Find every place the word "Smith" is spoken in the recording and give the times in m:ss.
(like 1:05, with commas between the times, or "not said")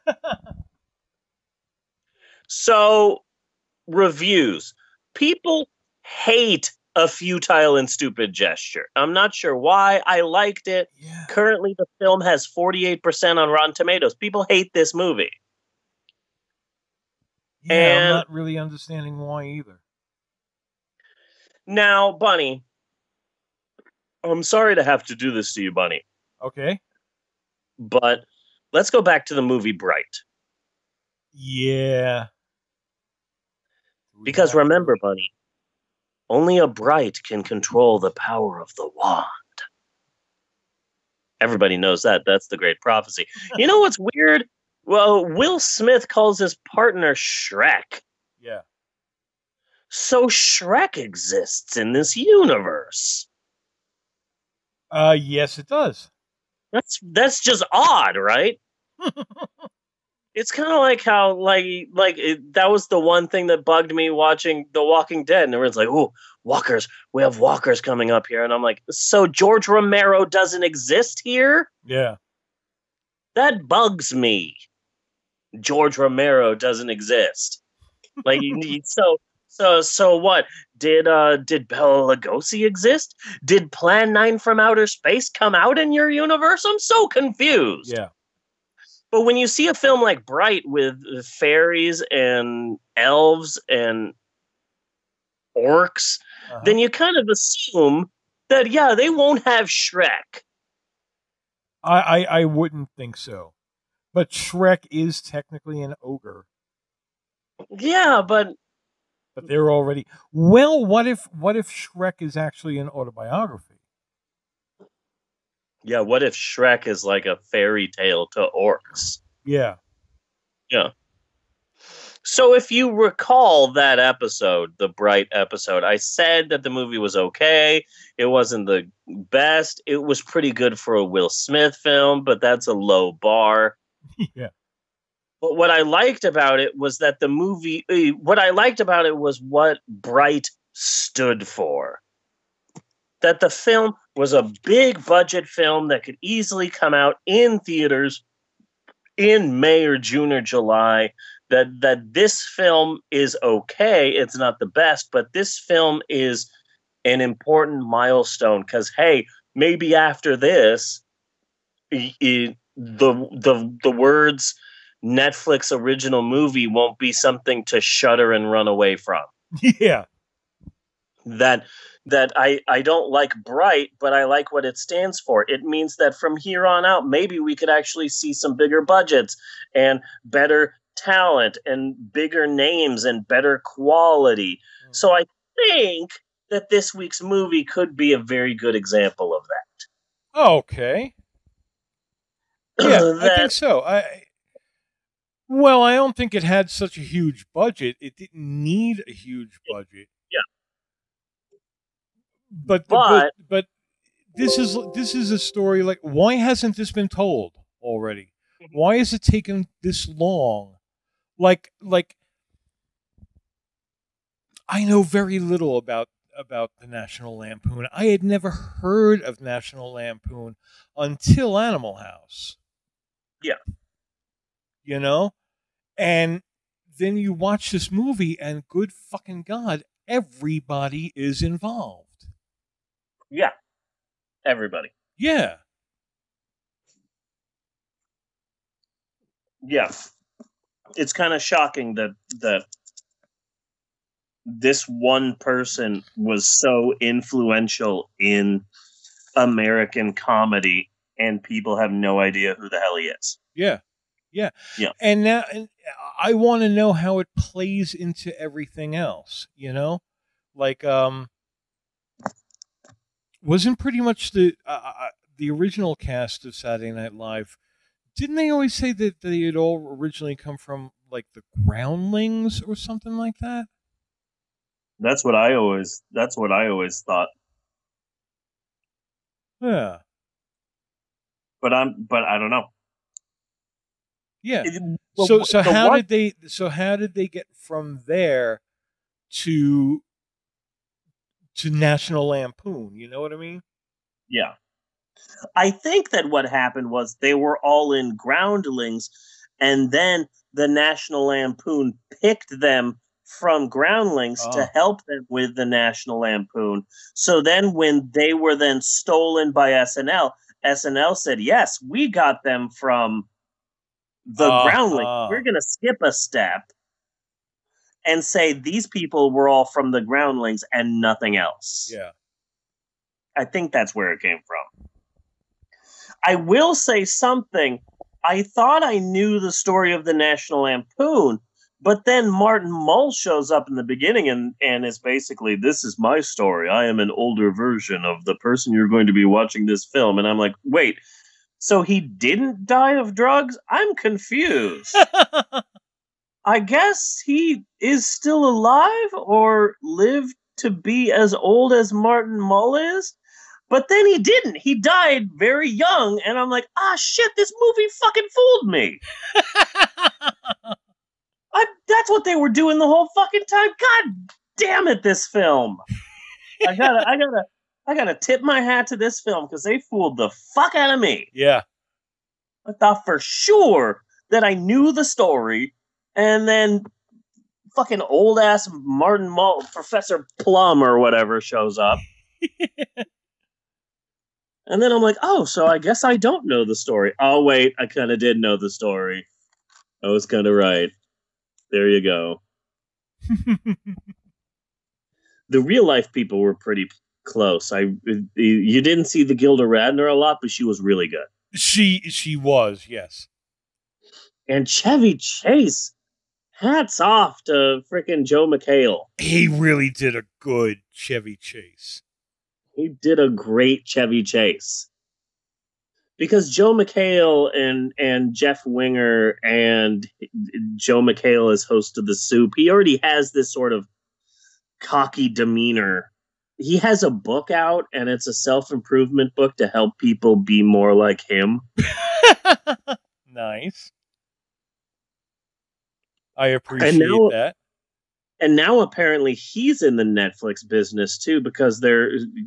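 0:45, 2:11.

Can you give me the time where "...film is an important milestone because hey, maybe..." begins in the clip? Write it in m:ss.
2:35.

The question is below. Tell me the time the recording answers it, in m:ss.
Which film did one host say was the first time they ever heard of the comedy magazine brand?
3:41.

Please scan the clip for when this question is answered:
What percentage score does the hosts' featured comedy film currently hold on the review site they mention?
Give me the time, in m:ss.
0:12.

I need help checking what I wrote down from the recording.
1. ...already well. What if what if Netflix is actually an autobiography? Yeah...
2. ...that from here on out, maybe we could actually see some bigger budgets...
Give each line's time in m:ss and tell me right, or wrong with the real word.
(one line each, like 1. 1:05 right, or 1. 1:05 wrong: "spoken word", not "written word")
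1. 1:49 wrong: "Shrek", not "Netflix"
2. 2:55 right.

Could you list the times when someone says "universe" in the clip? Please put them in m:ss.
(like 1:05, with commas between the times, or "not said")
0:52, 1:26.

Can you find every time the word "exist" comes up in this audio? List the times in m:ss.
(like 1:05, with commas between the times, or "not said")
0:50, 1:10, 1:16, 1:22.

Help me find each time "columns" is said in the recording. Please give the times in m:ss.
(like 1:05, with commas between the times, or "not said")
not said.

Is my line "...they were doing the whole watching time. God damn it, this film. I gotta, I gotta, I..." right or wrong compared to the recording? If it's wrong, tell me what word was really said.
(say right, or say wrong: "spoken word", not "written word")
wrong: "fucking", not "watching".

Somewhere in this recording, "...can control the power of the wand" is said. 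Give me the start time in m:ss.
0:37.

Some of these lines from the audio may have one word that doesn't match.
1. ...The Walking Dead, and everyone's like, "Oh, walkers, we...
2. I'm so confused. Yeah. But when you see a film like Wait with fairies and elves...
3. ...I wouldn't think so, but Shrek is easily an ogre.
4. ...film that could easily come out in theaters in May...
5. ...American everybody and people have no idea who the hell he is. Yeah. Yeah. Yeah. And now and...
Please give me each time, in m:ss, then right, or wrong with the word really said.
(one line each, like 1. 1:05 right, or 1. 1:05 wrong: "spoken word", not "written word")
1. 1:04 right
2. 1:26 wrong: "Bright", not "Wait"
3. 1:42 wrong: "technically", not "easily"
4. 2:25 right
5. 4:09 wrong: "comedy", not "everybody".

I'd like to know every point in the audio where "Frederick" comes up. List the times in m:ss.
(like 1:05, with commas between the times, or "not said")
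not said.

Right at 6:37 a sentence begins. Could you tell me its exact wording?
I you didn't see the Gilda Radner a lot, but she was really good.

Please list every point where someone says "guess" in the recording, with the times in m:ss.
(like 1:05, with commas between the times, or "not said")
5:46, 6:25.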